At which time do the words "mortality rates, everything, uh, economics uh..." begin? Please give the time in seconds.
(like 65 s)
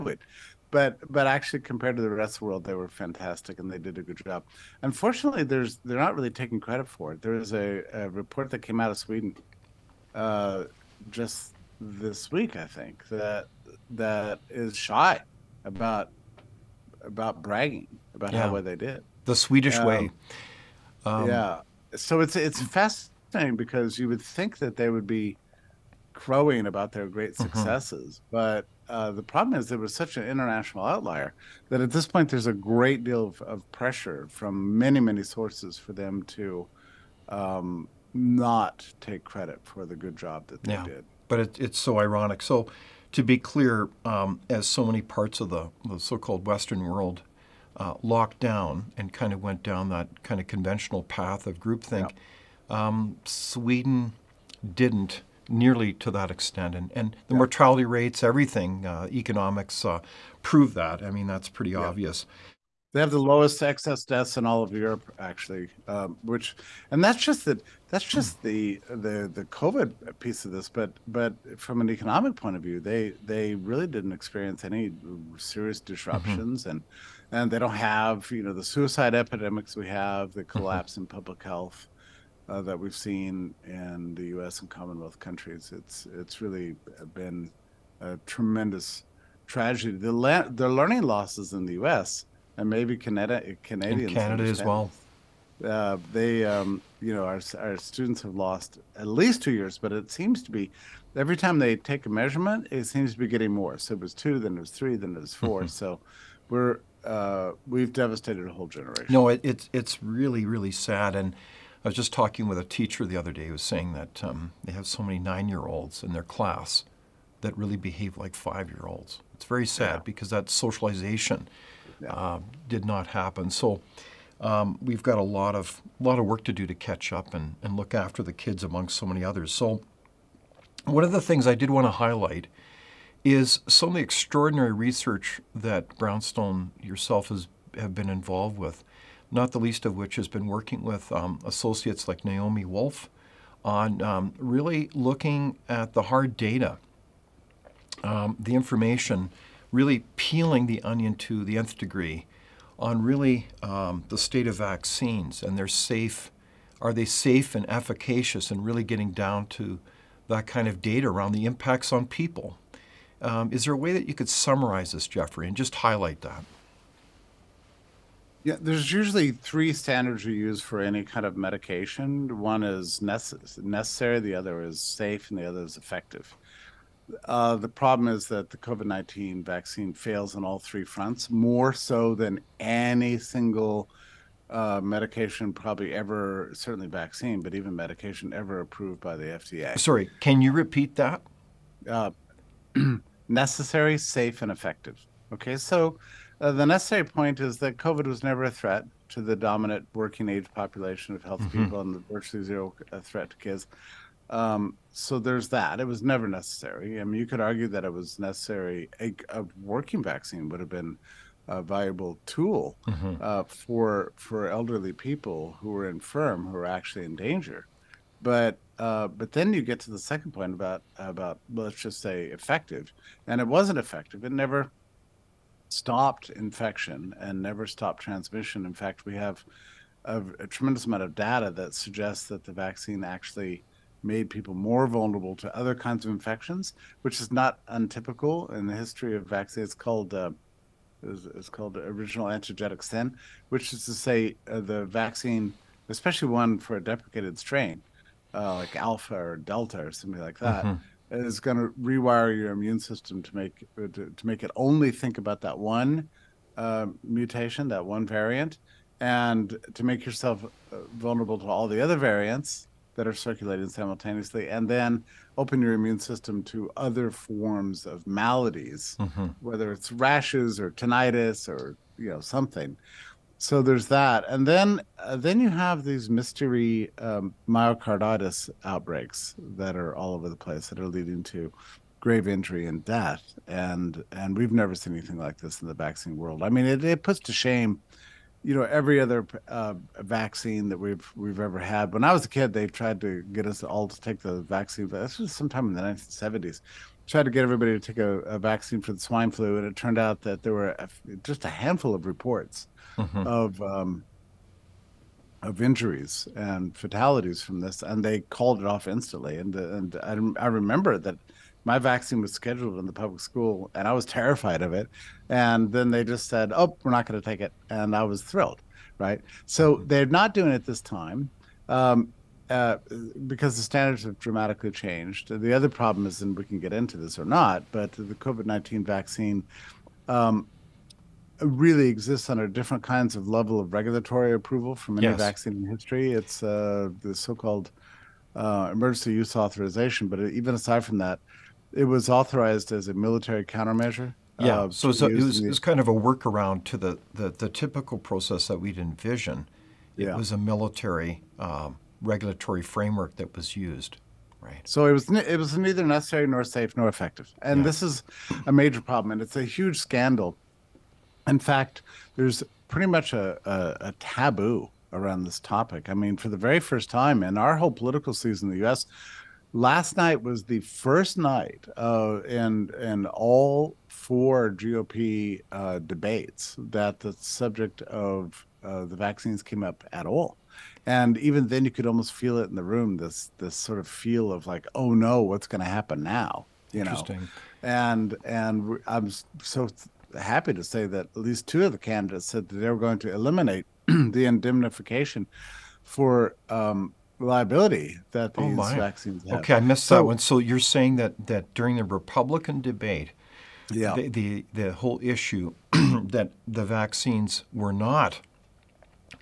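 57 s.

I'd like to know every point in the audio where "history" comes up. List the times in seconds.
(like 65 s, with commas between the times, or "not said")
238 s, 335 s.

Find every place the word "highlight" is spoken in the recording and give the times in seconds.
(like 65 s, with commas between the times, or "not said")
131 s, 165 s.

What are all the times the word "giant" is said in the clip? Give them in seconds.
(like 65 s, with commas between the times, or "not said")
not said.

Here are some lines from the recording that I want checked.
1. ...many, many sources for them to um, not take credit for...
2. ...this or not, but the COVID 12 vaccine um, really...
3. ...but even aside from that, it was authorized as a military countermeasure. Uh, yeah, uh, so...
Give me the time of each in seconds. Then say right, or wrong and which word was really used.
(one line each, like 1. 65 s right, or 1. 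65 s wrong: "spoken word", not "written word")
1. 34 s right
2. 326 s wrong: "19", not "12"
3. 340 s right.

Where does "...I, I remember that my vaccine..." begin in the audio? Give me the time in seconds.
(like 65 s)
310 s.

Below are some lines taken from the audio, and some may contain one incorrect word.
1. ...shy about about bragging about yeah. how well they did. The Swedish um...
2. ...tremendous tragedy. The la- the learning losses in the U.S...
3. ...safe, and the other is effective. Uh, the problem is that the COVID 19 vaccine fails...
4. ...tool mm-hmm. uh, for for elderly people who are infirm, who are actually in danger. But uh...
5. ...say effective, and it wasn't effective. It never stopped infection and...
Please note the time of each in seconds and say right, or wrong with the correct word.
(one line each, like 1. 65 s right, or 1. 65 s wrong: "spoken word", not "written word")
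1. 14 s right
2. 88 s right
3. 174 s right
4. 212 s right
5. 222 s right.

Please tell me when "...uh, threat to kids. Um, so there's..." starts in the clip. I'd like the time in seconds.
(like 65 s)
202 s.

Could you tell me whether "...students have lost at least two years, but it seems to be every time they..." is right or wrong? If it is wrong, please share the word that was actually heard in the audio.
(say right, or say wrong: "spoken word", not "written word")
right.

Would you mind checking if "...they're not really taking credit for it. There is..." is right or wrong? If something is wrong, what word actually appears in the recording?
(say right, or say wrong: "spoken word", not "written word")
right.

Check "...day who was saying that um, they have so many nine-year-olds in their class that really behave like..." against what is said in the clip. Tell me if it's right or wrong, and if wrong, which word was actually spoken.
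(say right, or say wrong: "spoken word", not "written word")
right.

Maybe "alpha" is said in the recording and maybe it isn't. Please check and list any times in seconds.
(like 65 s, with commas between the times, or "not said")
248 s.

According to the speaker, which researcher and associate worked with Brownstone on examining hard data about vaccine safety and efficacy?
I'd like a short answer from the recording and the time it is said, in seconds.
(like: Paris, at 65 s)
Naomi Wolf, at 142 s.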